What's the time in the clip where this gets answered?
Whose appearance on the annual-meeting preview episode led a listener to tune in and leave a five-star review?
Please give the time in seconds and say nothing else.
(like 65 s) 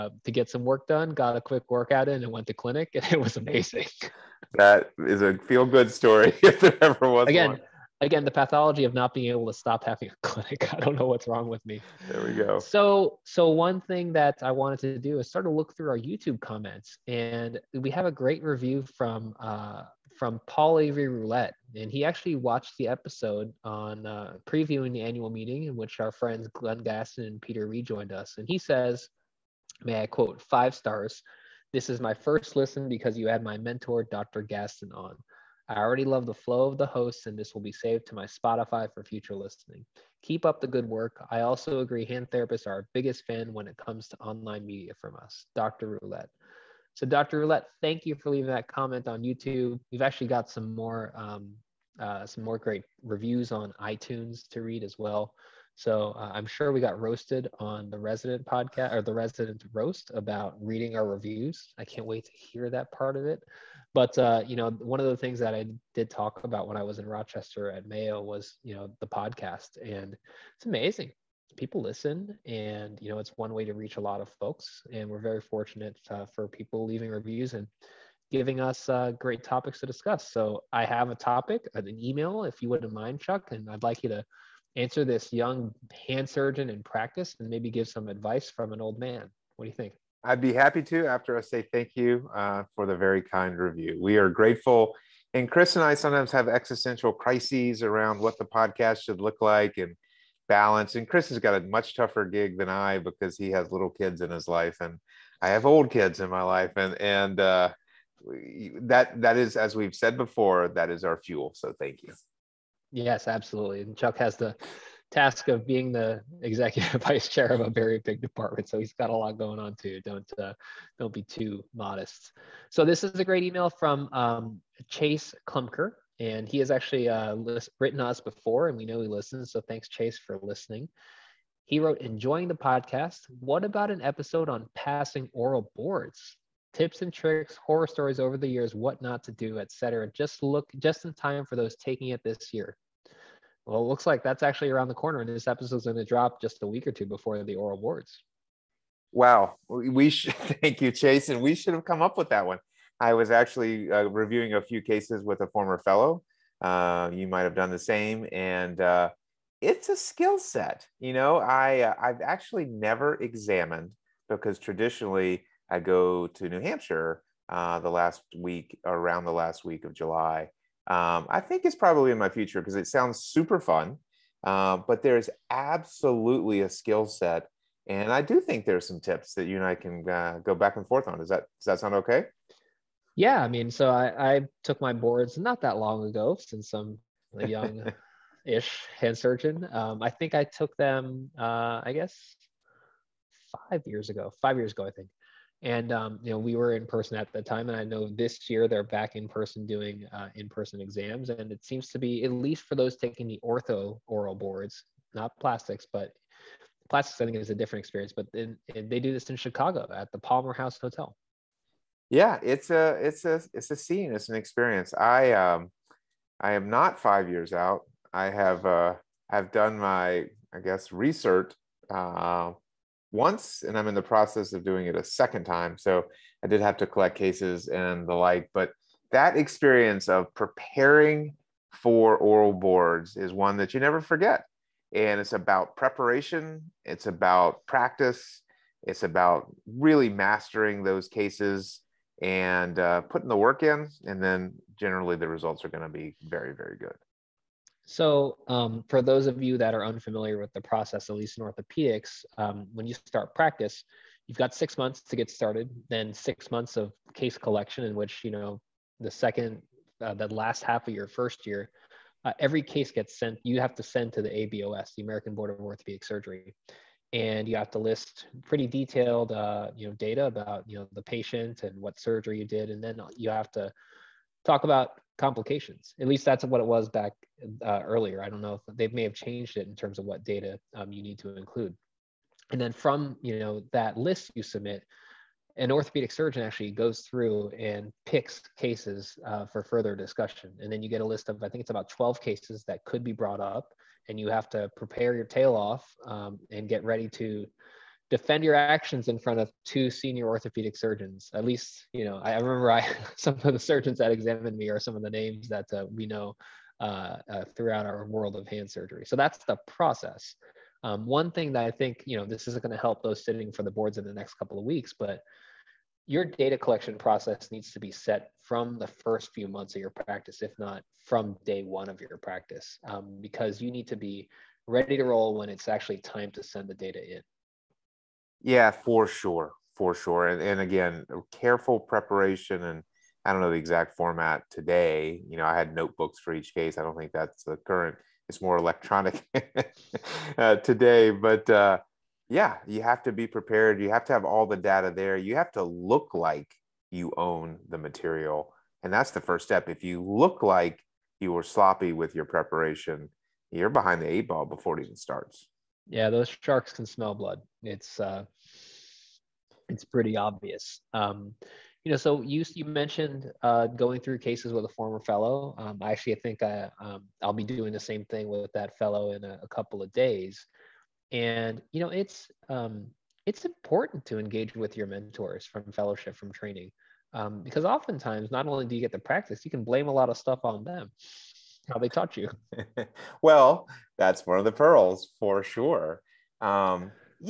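34 s.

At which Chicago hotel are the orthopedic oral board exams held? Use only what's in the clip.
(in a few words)
Palmer House Hotel.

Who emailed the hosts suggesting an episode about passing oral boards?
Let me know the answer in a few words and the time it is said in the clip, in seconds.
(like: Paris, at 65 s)
Chase Klumker, at 124 s.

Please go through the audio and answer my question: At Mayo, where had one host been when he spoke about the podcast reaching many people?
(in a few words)
Rochester.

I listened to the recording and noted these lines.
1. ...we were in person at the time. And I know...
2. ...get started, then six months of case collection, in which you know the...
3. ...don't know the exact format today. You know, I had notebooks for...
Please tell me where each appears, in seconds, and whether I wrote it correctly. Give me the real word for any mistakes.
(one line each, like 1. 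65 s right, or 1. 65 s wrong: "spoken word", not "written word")
1. 196 s right
2. 255 s right
3. 333 s right.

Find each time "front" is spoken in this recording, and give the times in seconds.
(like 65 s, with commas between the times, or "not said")
299 s.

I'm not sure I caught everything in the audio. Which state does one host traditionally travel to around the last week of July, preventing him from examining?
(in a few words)
New Hampshire.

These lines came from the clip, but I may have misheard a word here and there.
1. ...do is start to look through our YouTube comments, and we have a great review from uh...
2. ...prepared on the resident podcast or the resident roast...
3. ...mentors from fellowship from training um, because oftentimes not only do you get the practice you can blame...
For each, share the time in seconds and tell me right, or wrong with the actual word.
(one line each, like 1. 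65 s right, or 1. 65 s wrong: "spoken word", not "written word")
1. 14 s right
2. 56 s wrong: "roasted", not "prepared"
3. 374 s right.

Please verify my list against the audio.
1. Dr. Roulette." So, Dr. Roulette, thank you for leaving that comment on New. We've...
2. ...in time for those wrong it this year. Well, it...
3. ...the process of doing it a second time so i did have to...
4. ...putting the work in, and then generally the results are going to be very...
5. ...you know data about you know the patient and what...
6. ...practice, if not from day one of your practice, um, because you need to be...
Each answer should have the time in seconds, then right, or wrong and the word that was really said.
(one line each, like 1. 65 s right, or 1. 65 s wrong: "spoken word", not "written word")
1. 45 s wrong: "YouTube", not "New"
2. 141 s wrong: "taking", not "wrong"
3. 223 s right
4. 243 s right
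5. 269 s right
6. 319 s right.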